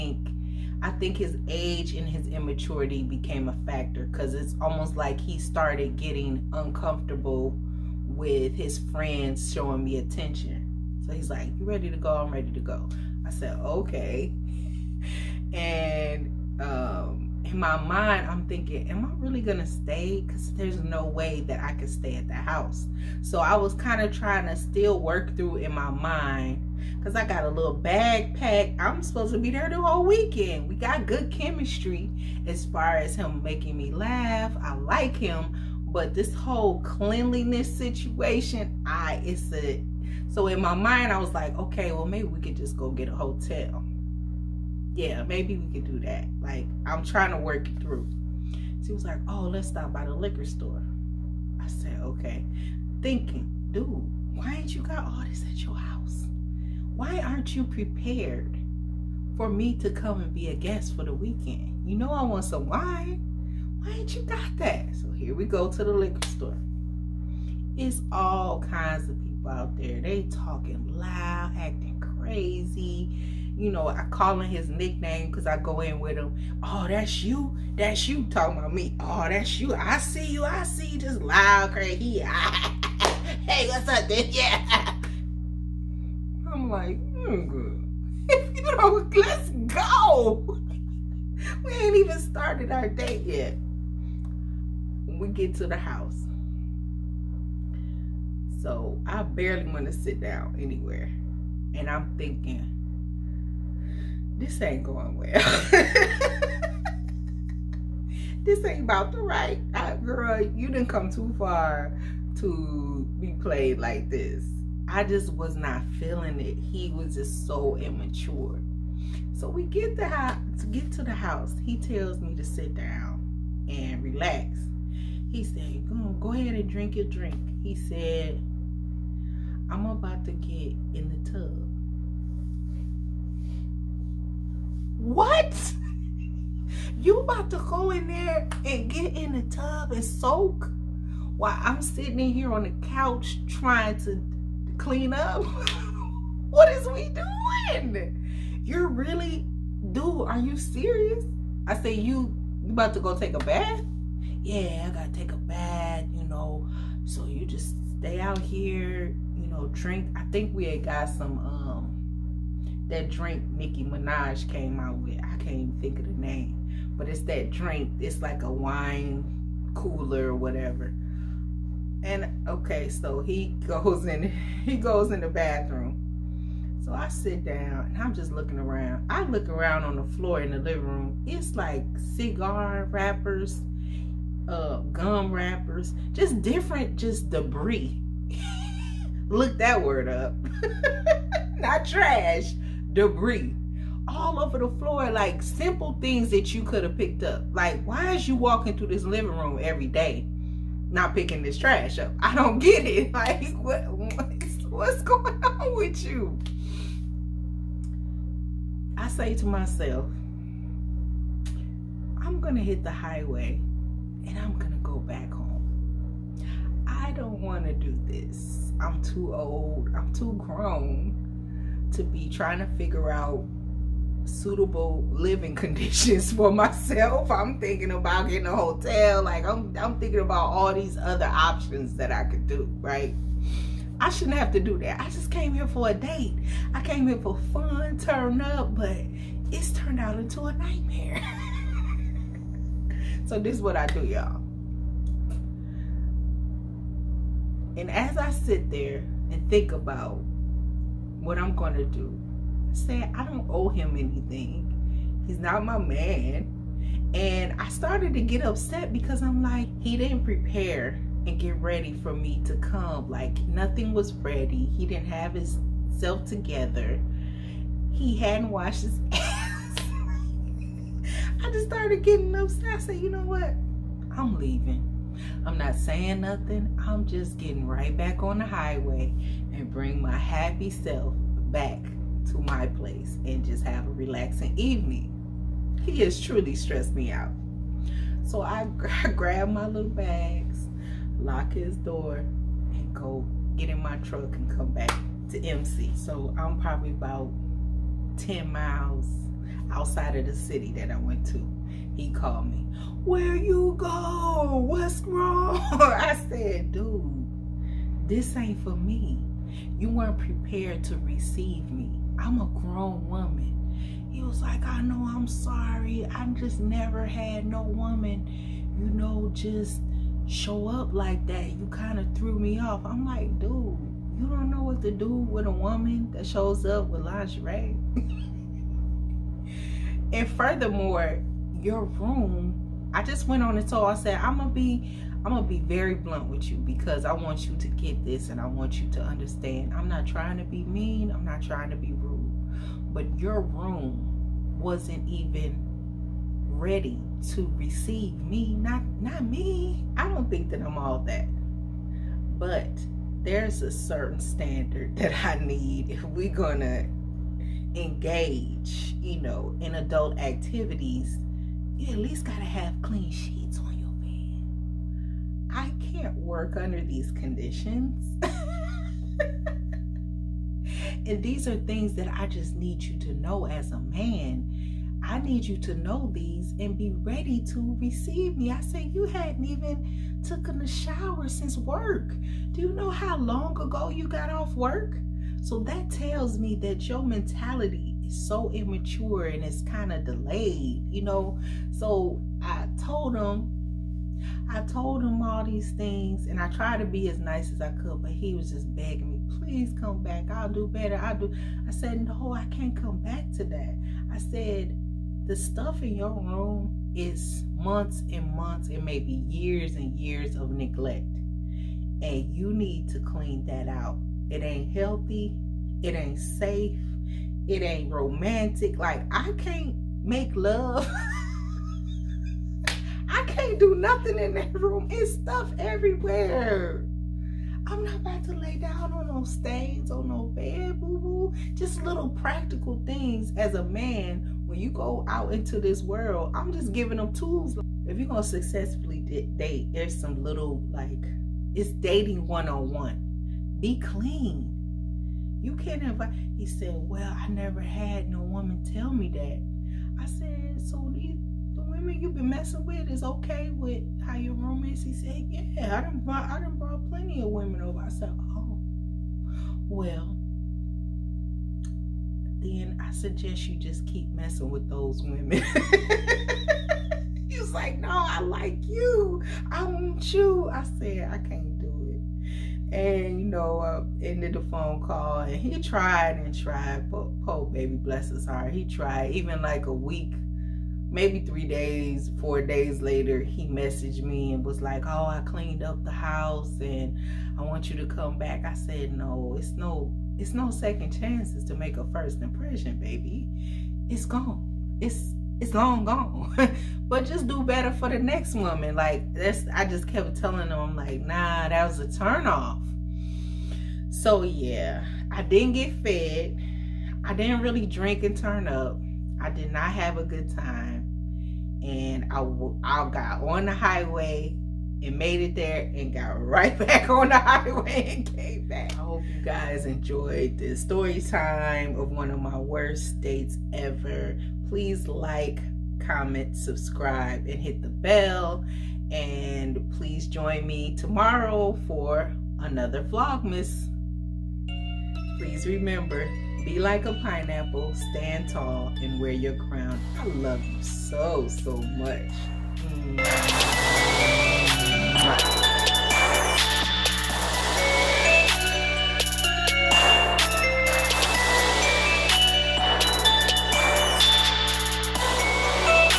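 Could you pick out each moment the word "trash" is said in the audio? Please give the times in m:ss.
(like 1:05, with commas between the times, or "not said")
3:11, 3:21.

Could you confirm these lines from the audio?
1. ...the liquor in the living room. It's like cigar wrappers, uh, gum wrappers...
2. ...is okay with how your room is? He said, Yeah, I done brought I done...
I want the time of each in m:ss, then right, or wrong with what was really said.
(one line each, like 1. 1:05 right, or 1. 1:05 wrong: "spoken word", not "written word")
1. 2:59 wrong: "floor", not "liquor"
2. 7:32 right.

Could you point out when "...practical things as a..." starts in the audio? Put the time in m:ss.
7:12.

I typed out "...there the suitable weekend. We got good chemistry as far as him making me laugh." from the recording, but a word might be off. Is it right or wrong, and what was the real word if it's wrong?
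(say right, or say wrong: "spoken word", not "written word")
wrong: "whole", not "suitable".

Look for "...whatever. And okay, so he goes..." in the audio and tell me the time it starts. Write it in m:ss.
2:50.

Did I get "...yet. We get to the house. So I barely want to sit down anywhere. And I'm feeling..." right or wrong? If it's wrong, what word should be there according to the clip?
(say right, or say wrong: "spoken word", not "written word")
wrong: "thinking", not "feeling".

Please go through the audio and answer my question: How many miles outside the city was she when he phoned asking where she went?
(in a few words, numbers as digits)
10.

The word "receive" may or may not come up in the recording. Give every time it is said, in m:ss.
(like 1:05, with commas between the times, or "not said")
5:11, 5:47, 6:17.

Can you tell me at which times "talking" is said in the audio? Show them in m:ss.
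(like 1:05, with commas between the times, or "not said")
1:10, 1:18.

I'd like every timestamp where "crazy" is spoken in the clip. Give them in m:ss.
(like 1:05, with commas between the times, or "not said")
1:11, 1:21.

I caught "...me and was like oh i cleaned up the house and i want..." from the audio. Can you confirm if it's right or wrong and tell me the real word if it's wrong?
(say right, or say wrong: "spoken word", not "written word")
right.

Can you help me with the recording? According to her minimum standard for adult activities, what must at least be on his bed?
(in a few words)
Clean sheets.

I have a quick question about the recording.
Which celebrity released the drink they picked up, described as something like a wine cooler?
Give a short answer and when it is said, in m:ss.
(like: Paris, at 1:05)
Nicki Minaj, at 2:43.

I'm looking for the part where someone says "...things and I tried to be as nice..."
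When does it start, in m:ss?
6:35.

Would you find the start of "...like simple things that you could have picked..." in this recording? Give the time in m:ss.
3:15.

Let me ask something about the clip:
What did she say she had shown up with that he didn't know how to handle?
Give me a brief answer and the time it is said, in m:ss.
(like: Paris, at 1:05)
Lingerie, at 5:27.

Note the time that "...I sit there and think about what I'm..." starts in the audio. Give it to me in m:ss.
4:08.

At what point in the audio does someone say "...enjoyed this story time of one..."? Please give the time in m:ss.
8:39.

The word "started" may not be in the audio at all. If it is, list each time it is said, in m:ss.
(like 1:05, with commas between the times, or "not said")
0:05, 1:32, 4:17, 4:31.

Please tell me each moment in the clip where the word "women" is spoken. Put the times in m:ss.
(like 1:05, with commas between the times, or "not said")
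7:31, 7:37, 7:45.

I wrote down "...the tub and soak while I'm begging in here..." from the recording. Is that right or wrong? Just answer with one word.
wrong.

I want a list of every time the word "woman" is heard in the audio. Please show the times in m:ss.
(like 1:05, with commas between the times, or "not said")
5:13, 5:17, 5:25, 7:28, 8:18.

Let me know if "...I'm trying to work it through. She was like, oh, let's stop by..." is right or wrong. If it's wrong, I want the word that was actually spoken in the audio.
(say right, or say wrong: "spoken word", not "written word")
right.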